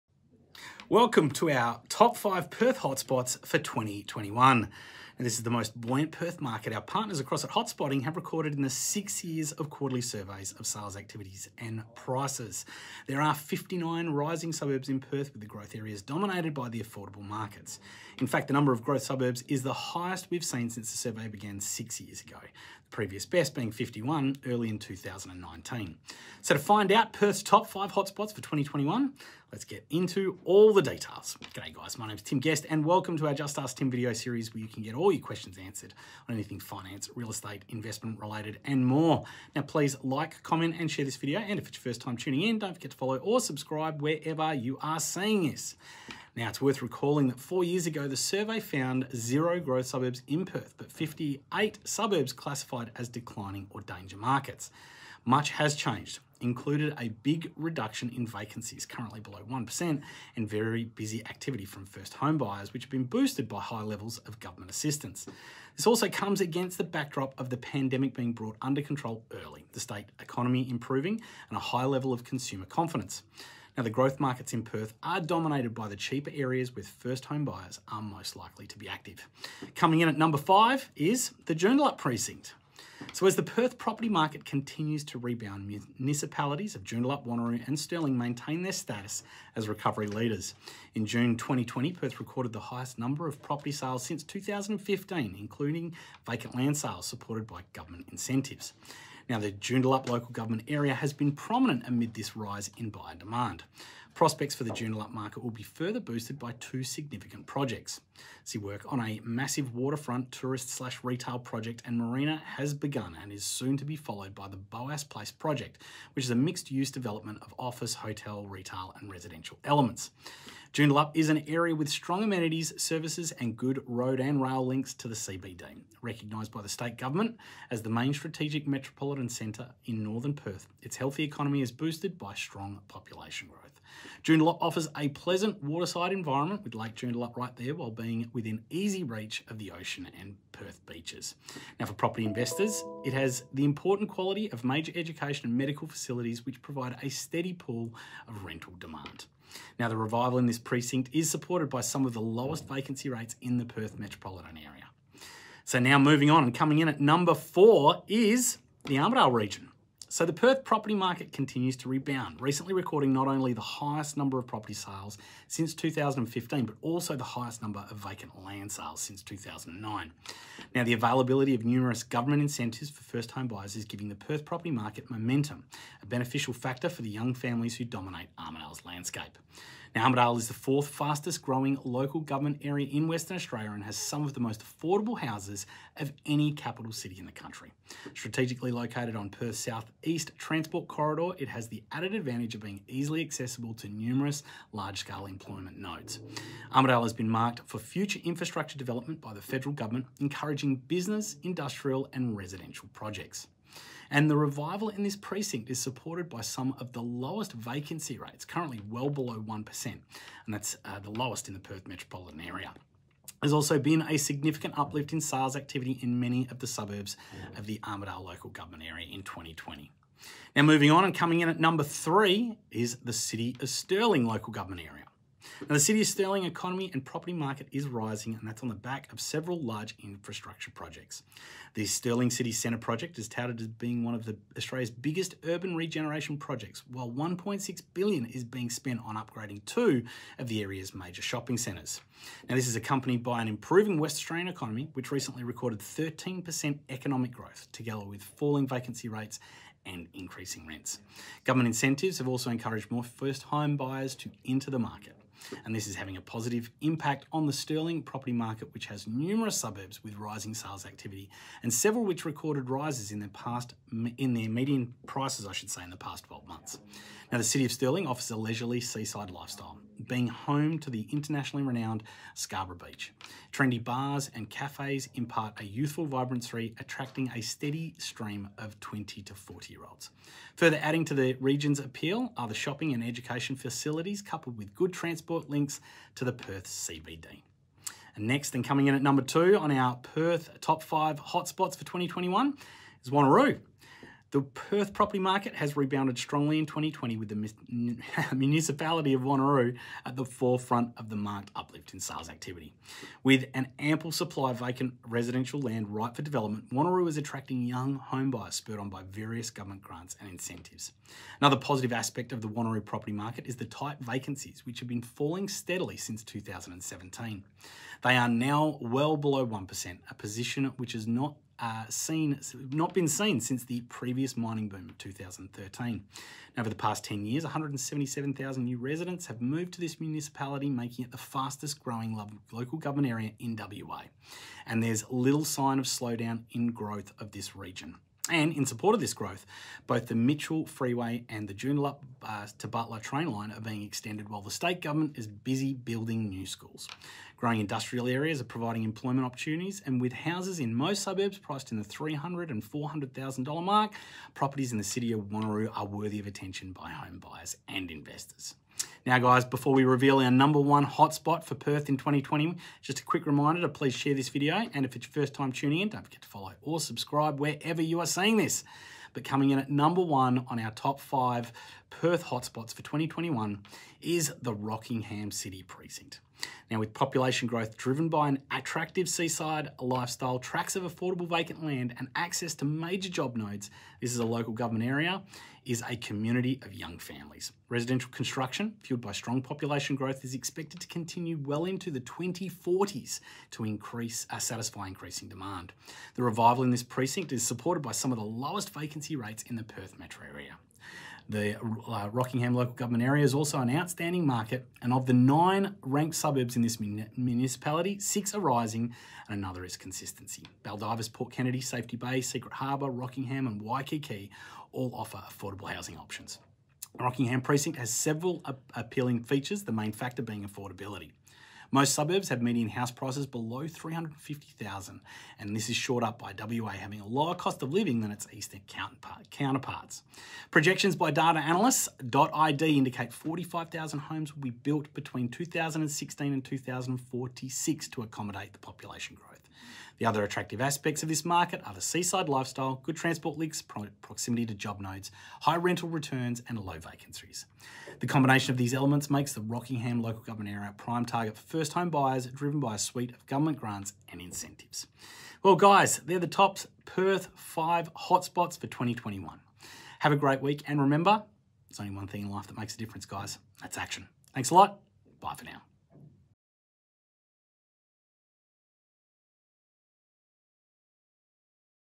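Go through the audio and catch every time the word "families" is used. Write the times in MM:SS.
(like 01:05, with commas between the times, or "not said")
02:57, 06:26.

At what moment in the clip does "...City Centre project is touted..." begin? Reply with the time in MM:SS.
03:52.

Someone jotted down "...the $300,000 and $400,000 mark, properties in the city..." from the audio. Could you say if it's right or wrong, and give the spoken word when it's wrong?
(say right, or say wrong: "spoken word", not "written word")
right.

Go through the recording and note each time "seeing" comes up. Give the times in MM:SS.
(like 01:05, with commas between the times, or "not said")
00:45, 06:08.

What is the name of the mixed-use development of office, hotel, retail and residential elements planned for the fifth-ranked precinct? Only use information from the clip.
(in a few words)
Boas Place.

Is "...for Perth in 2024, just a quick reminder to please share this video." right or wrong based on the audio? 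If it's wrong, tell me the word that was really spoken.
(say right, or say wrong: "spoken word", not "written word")
wrong: "2020", not "2024".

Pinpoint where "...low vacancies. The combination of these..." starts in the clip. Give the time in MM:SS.
07:26.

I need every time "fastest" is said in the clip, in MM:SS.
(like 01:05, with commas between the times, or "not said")
03:00, 05:31.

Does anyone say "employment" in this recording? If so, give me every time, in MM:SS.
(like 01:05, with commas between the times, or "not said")
03:15, 05:48.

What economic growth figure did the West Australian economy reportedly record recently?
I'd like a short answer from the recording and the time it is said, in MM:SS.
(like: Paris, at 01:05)
13%, at 04:05.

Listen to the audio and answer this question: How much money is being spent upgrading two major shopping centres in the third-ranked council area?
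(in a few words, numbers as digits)
1.6 billion.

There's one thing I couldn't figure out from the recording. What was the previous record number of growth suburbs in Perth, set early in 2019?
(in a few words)
51.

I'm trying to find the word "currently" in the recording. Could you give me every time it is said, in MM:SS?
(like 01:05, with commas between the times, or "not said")
00:58, 03:28.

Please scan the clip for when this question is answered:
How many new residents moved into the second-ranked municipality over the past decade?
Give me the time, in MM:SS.
05:27.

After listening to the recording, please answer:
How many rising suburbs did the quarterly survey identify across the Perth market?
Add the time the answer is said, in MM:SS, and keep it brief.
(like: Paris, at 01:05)
59, at 00:13.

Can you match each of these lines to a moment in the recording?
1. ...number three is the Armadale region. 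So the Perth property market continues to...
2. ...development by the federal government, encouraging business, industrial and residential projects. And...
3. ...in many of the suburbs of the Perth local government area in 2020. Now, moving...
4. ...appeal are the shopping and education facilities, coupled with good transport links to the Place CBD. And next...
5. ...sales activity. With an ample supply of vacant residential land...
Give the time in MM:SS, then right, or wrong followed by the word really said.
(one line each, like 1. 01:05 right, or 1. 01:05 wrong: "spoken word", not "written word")
1. 02:36 wrong: "four", not "three"
2. 03:18 right
3. 03:36 wrong: "Armadale", not "Perth"
4. 04:41 wrong: "Perth", not "Place"
5. 05:01 right.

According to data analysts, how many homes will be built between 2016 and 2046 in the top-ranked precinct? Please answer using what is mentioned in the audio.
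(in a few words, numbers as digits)
45,000.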